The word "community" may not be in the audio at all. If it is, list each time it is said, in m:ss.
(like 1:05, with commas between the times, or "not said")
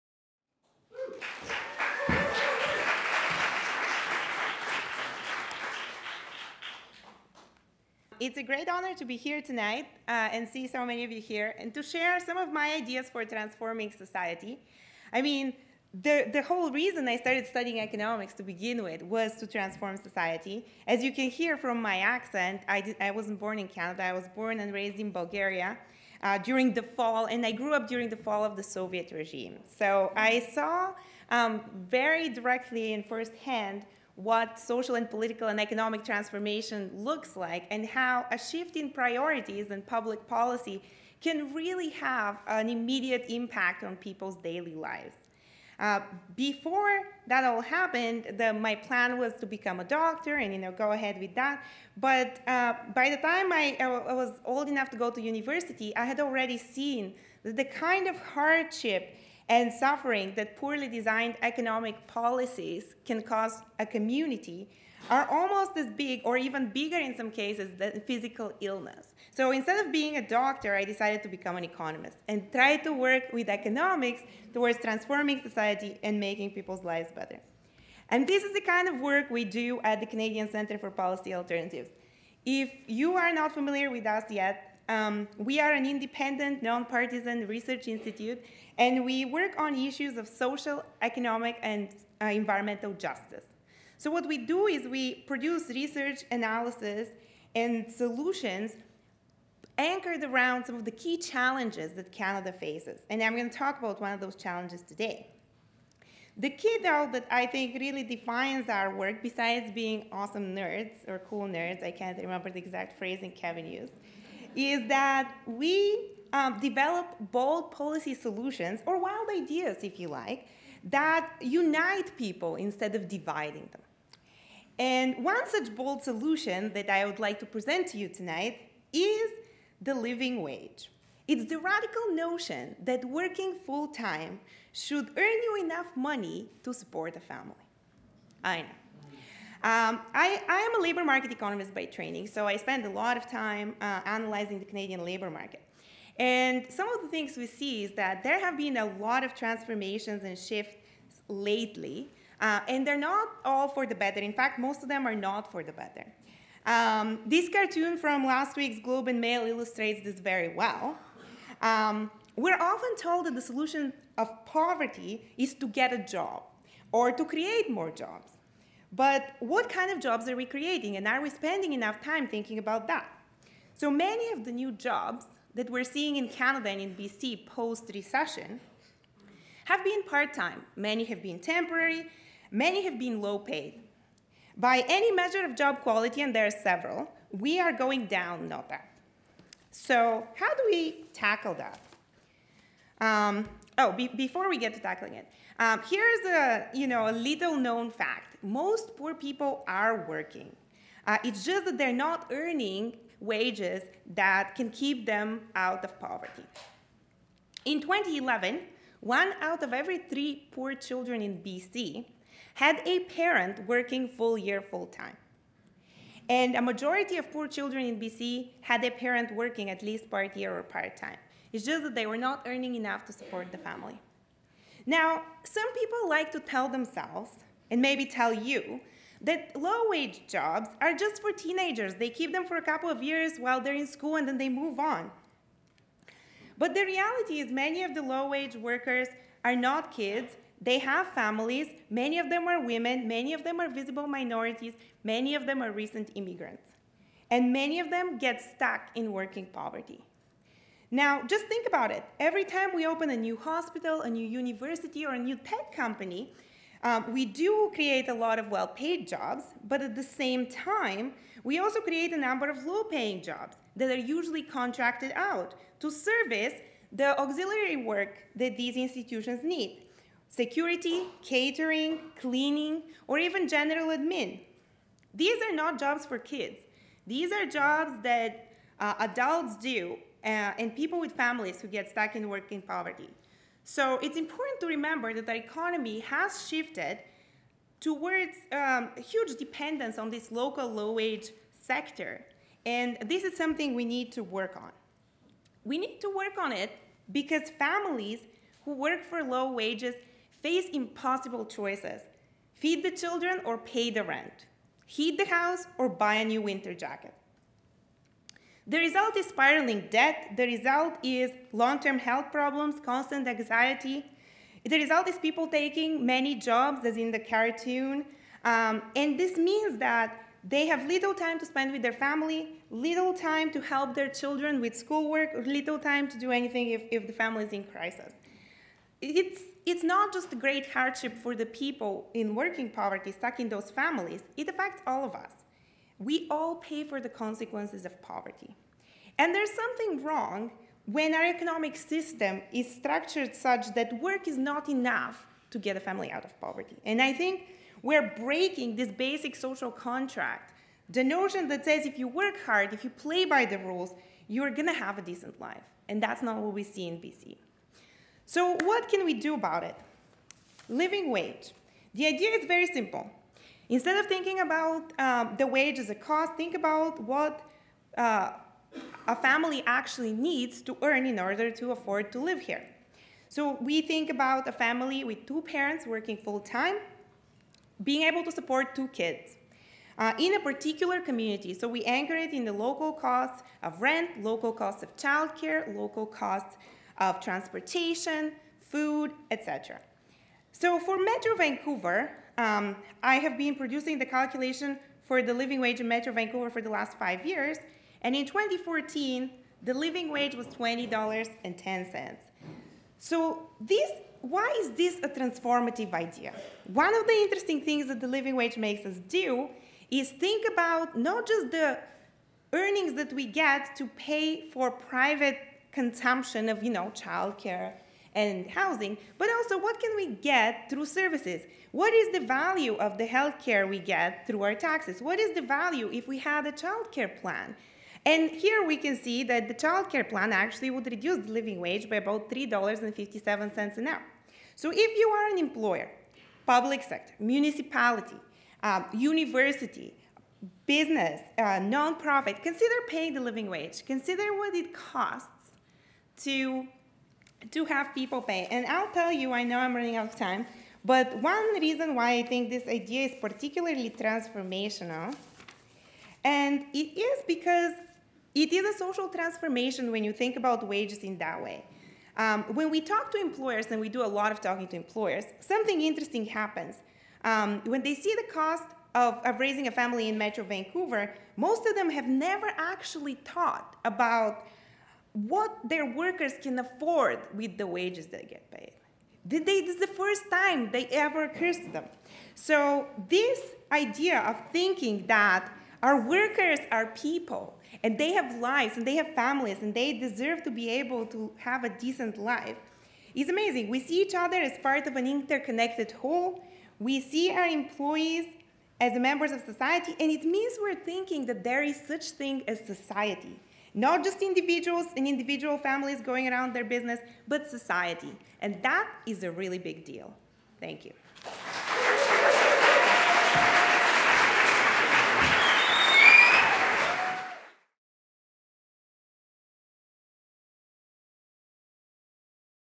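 1:03, 6:20.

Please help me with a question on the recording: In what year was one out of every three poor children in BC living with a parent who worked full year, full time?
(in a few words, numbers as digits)
2011.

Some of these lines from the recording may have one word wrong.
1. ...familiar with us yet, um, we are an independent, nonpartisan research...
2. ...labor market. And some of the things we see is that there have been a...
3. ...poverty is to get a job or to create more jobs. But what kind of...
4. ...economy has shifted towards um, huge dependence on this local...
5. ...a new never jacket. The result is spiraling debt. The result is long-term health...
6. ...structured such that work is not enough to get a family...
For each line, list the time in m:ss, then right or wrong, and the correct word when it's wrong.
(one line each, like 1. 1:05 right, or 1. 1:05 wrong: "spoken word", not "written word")
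1. 1:23 right
2. 2:25 right
3. 2:44 right
4. 4:45 right
5. 5:06 wrong: "winter", not "never"
6. 5:42 right.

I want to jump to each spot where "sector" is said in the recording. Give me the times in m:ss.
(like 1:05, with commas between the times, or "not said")
4:51, 7:16.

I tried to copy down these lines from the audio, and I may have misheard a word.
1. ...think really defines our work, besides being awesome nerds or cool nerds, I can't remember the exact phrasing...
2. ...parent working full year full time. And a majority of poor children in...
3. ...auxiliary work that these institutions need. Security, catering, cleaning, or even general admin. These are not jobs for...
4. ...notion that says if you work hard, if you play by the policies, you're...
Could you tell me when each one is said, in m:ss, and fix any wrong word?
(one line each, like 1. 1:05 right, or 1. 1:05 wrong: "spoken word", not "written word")
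1. 1:47 right
2. 3:33 right
3. 4:27 right
4. 5:51 wrong: "rules", not "policies".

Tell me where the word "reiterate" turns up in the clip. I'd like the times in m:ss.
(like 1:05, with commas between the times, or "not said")
not said.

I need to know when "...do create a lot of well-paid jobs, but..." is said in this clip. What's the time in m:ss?
4:17.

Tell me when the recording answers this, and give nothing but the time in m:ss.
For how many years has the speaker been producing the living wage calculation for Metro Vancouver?
6:36.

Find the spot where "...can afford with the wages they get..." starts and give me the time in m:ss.
7:56.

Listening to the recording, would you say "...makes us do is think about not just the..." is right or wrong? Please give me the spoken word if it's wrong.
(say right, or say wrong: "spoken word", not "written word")
right.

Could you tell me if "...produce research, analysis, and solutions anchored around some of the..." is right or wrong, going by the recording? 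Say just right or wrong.
right.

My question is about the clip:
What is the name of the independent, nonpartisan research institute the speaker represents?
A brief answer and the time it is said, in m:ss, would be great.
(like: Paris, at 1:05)
Canadian Center for Policy Alternatives, at 1:20.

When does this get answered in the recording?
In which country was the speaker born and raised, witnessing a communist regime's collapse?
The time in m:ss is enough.
0:25.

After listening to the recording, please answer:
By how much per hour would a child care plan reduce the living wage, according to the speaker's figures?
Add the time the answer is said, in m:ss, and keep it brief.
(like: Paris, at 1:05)
$3.57, at 7:12.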